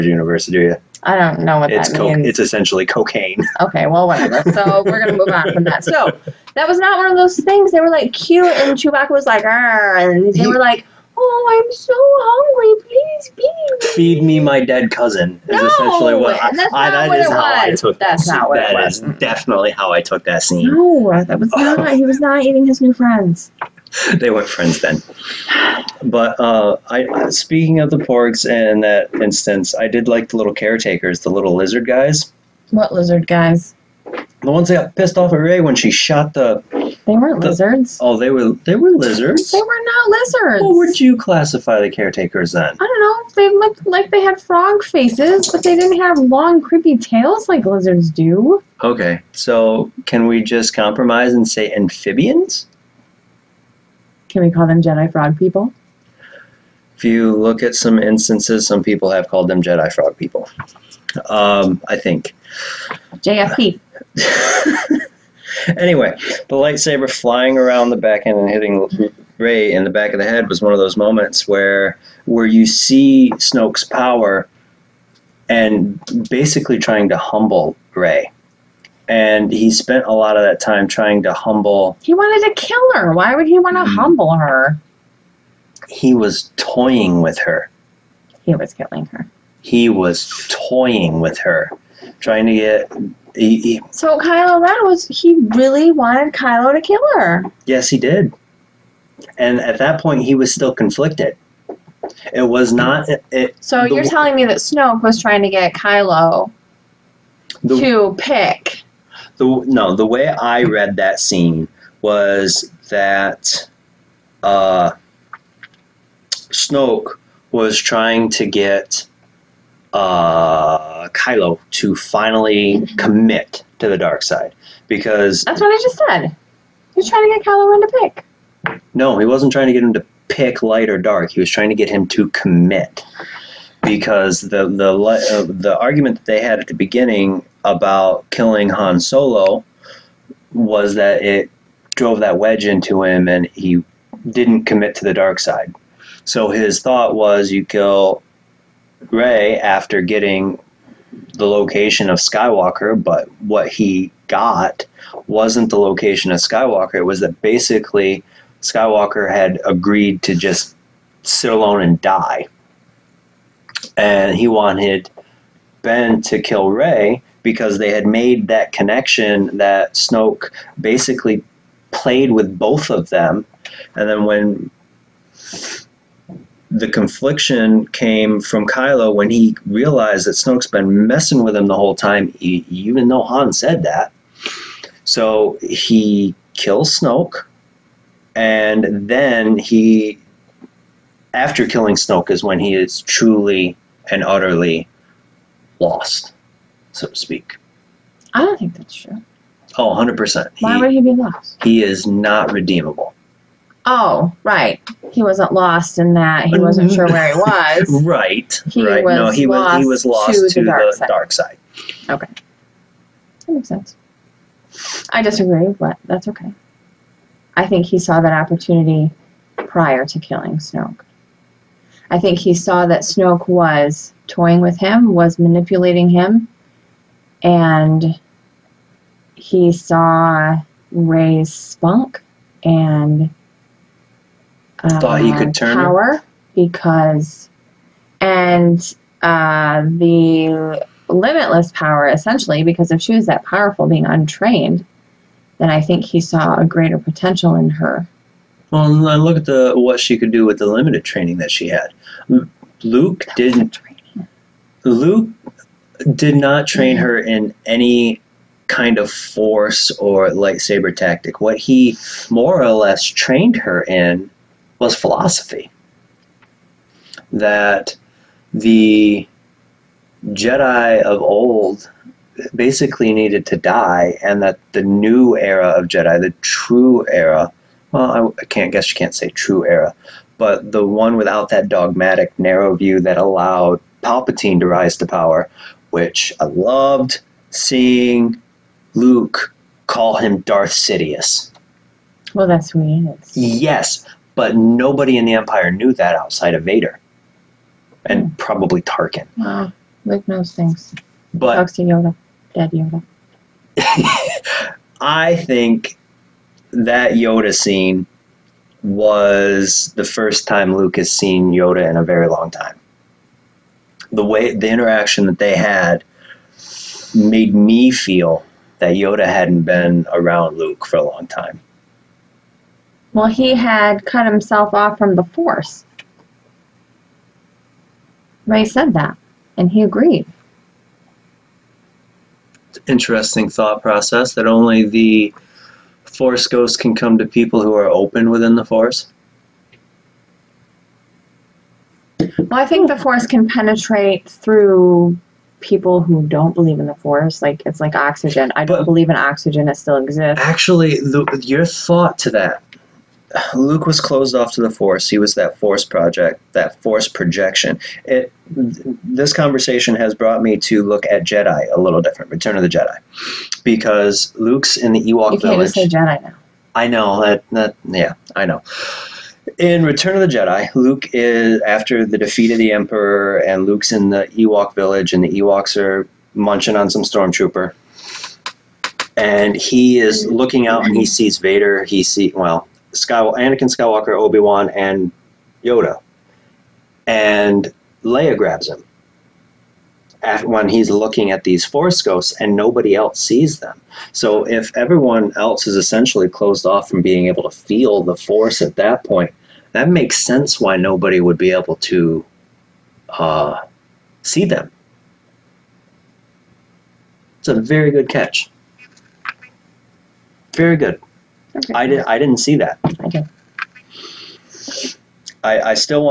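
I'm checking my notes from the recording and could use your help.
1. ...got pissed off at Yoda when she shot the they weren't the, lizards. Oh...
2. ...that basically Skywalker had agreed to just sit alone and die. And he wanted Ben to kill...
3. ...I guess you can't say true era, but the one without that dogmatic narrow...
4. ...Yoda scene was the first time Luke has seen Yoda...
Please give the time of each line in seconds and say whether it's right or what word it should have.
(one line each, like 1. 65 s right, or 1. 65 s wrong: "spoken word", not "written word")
1. 34 s wrong: "Rey", not "Yoda"
2. 157 s right
3. 278 s right
4. 307 s right.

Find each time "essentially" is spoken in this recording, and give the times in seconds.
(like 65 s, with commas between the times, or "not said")
2 s, 15 s, 242 s, 395 s.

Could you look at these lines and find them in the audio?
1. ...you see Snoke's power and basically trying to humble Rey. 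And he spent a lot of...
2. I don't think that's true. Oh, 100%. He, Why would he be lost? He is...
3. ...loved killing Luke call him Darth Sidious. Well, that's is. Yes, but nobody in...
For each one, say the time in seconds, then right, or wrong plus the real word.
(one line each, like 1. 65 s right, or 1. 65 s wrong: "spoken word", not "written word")
1. 72 s right
2. 198 s right
3. 286 s wrong: "seeing", not "killing".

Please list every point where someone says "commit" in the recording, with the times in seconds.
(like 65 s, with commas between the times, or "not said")
122 s, 132 s, 144 s.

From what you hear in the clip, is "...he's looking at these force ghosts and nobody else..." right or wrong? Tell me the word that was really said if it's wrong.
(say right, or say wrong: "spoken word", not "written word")
right.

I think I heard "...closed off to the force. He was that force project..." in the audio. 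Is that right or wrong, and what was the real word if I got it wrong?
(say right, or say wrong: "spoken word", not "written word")
right.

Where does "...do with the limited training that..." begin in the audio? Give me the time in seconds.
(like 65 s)
250 s.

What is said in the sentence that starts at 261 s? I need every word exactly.
What he more or less trained her in was philosophy.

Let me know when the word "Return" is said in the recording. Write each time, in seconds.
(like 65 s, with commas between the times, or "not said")
362 s, 369 s.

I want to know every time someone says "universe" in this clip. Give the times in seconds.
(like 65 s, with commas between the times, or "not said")
0 s.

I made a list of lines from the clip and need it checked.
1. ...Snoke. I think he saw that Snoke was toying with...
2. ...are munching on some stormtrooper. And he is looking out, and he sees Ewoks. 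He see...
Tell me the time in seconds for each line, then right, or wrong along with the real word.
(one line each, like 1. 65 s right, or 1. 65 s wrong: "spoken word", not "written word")
1. 220 s right
2. 375 s wrong: "Vader", not "Ewoks".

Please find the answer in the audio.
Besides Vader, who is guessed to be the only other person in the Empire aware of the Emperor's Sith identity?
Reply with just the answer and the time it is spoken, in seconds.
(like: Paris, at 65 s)
Tarkin, at 298 s.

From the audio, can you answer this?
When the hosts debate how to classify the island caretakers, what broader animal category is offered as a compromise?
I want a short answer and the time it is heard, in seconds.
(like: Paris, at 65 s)
amphibians, at 51 s.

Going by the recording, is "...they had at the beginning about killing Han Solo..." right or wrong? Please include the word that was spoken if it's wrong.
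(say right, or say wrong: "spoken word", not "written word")
right.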